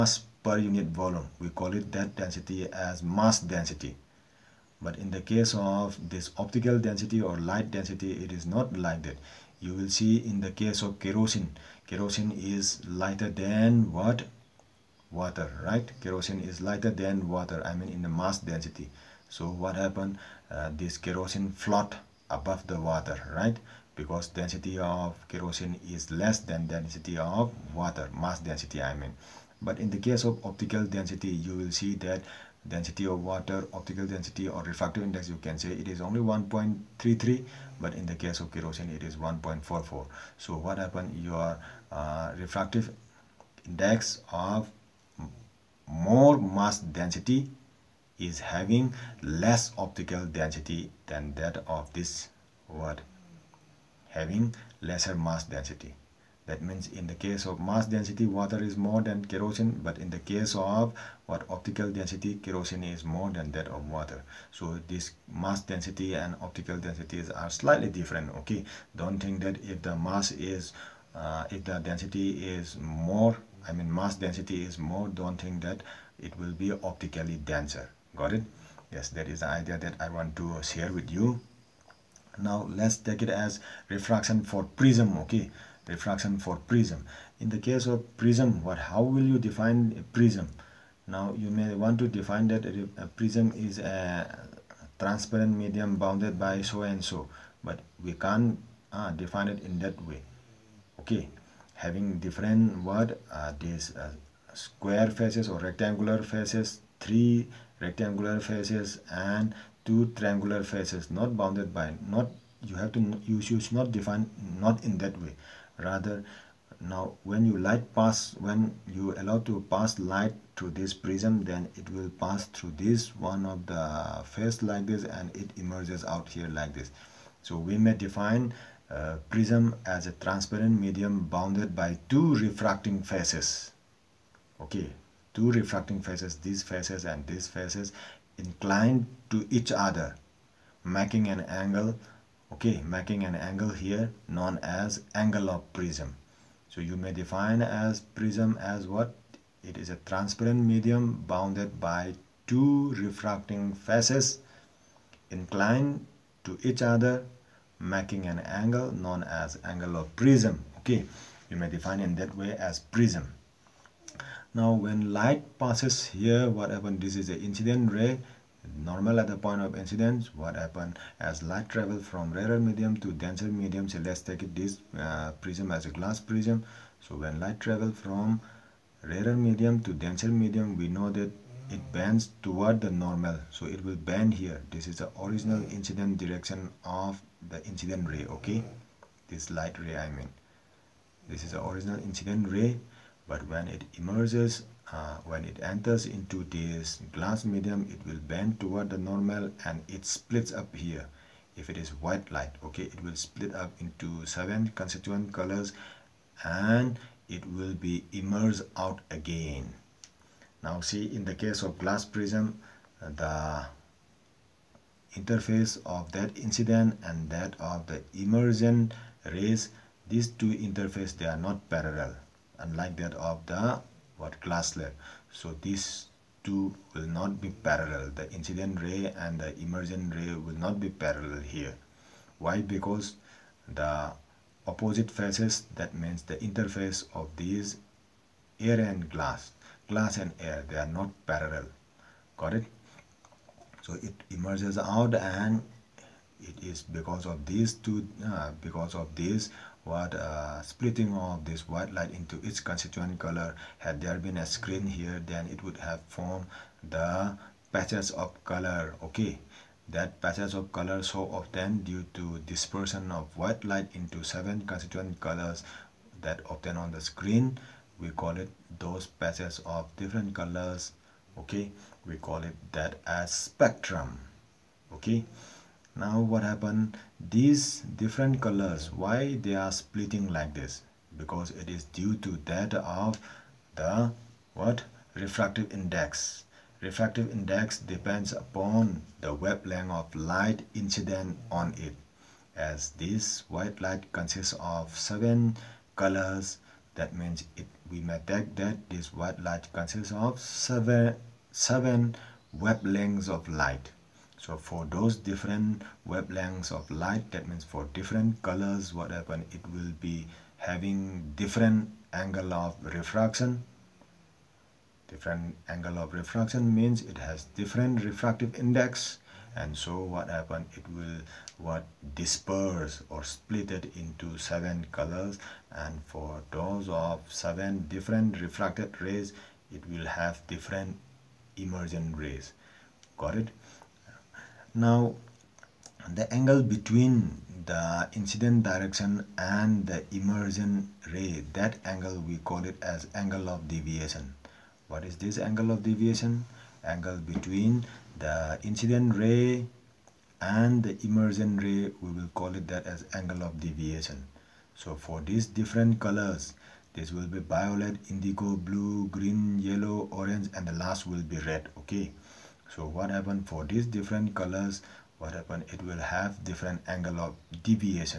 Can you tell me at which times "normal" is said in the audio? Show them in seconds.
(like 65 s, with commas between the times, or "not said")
168 s, 182 s, 198 s.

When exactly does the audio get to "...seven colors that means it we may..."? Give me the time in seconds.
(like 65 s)
294 s.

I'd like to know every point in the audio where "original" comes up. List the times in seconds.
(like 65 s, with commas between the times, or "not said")
185 s, 191 s.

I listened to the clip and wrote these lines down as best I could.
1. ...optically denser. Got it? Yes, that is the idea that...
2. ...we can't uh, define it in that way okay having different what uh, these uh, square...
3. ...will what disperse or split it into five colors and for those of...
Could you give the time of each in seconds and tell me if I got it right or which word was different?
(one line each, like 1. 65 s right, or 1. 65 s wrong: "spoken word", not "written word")
1. 76 s right
2. 98 s right
3. 320 s wrong: "seven", not "five".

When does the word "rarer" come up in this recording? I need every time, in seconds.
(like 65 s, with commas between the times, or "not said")
172 s, 179 s.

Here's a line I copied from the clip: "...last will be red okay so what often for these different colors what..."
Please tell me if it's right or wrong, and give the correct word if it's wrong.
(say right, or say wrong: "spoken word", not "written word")
wrong: "happen", not "often".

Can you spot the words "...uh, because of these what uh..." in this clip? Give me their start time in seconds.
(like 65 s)
248 s.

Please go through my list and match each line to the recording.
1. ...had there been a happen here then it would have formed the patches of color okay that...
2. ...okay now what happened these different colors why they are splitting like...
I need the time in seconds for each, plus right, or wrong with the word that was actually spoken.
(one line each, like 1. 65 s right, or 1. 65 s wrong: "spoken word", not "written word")
1. 253 s wrong: "screen", not "happen"
2. 274 s right.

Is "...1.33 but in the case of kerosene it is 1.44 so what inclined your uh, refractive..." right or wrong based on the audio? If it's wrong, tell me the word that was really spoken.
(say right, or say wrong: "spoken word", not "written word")
wrong: "happened", not "inclined".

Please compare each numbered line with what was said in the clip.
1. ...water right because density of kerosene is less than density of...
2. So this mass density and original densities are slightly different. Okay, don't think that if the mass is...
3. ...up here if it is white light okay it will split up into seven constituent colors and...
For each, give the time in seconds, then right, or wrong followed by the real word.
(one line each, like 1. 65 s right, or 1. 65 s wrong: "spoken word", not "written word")
1. 22 s right
2. 64 s wrong: "optical", not "original"
3. 200 s right.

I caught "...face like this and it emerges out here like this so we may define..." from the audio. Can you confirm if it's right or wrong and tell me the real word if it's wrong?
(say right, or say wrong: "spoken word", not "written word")
right.